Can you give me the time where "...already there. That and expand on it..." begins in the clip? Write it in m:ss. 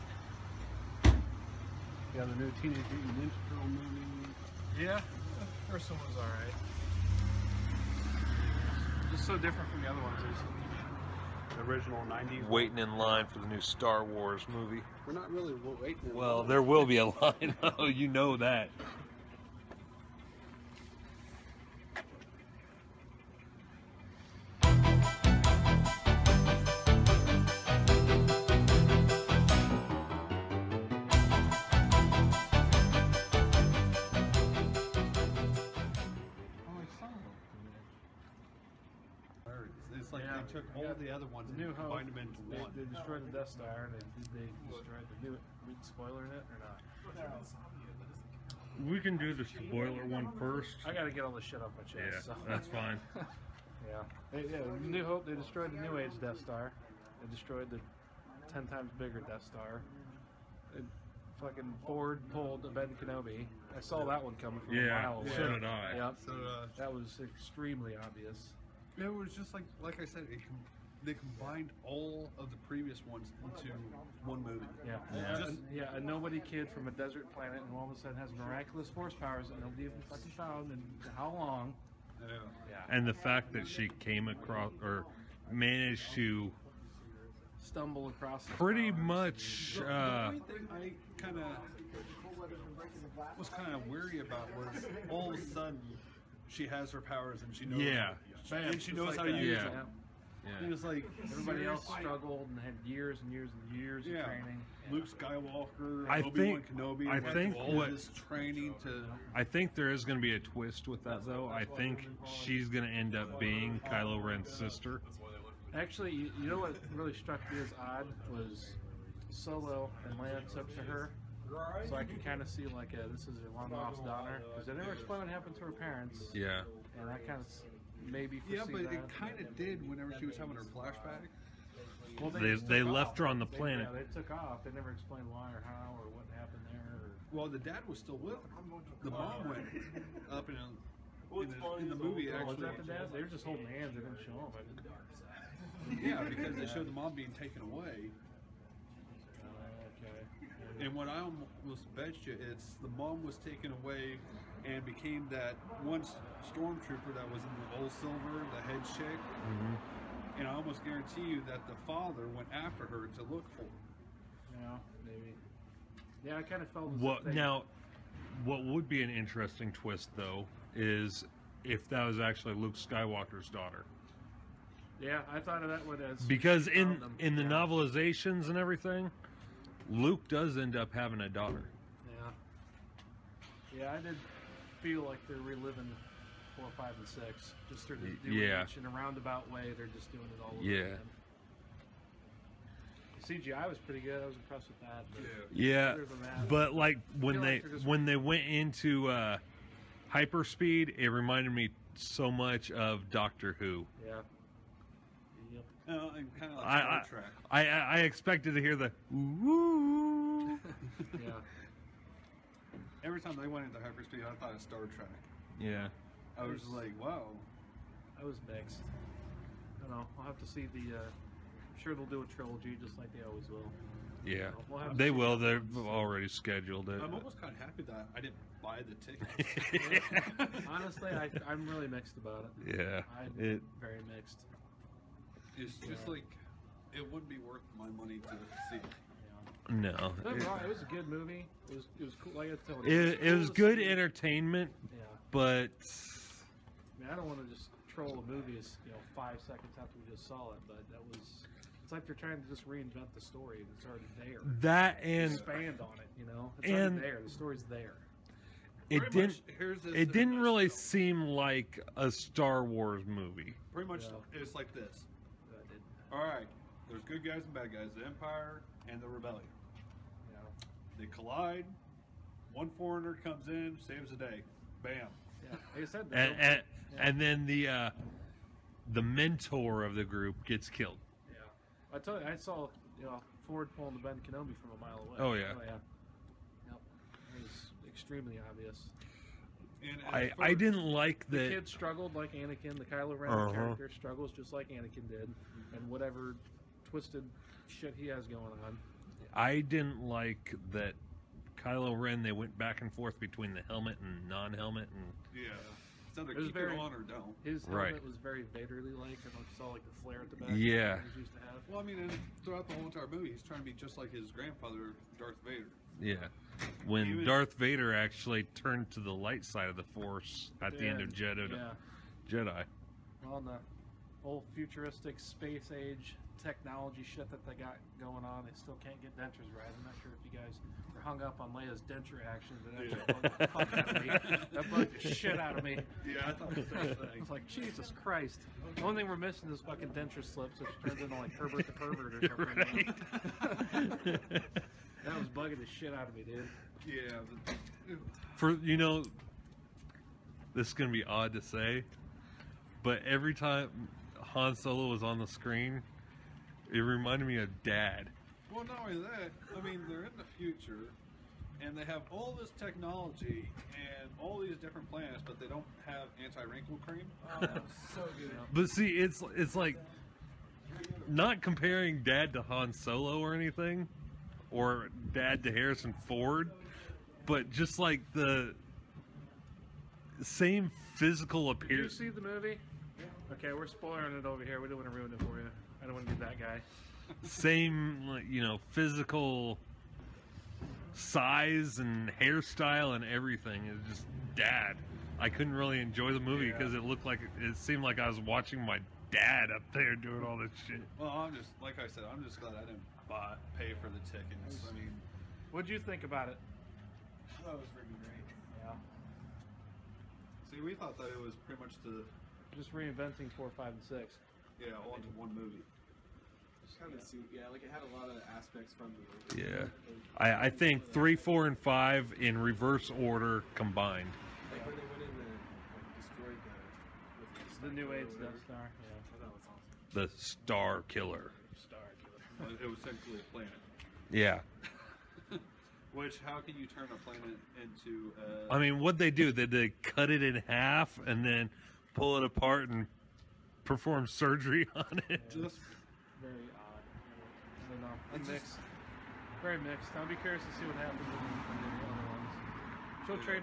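4:13.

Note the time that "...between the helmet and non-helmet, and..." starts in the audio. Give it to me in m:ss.
5:03.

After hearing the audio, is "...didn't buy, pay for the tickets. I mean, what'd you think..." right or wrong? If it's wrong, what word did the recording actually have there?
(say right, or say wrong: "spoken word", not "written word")
right.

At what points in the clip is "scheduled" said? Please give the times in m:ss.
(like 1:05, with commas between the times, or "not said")
3:46.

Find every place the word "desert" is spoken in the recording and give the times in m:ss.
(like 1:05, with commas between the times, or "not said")
1:16.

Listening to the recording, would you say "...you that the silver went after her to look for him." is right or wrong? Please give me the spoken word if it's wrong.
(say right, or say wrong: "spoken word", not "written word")
wrong: "father", not "silver".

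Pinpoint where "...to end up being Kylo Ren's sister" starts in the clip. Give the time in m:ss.
1:52.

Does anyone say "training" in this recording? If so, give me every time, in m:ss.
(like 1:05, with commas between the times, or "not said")
1:44, 1:48.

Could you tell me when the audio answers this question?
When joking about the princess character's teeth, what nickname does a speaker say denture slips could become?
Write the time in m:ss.
5:41.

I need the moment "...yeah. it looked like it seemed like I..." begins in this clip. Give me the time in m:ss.
6:36.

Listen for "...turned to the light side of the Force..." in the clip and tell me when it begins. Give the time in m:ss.
5:18.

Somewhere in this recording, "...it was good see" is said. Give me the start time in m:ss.
4:03.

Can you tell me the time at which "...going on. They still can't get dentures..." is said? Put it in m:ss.
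5:28.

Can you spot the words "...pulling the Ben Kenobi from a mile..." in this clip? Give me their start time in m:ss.
4:43.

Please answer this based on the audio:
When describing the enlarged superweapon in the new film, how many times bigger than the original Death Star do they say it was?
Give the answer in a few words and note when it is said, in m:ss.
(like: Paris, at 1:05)
10, at 0:58.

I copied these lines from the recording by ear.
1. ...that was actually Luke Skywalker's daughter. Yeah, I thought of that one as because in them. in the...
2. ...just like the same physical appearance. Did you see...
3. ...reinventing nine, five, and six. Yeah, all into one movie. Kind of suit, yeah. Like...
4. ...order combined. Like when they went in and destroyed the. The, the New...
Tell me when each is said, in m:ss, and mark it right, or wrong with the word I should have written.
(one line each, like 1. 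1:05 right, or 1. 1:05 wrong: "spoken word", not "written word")
1. 2:51 right
2. 6:17 right
3. 6:52 wrong: "four", not "nine"
4. 7:03 right.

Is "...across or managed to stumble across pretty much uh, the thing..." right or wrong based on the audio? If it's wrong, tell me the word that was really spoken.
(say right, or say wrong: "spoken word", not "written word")
right.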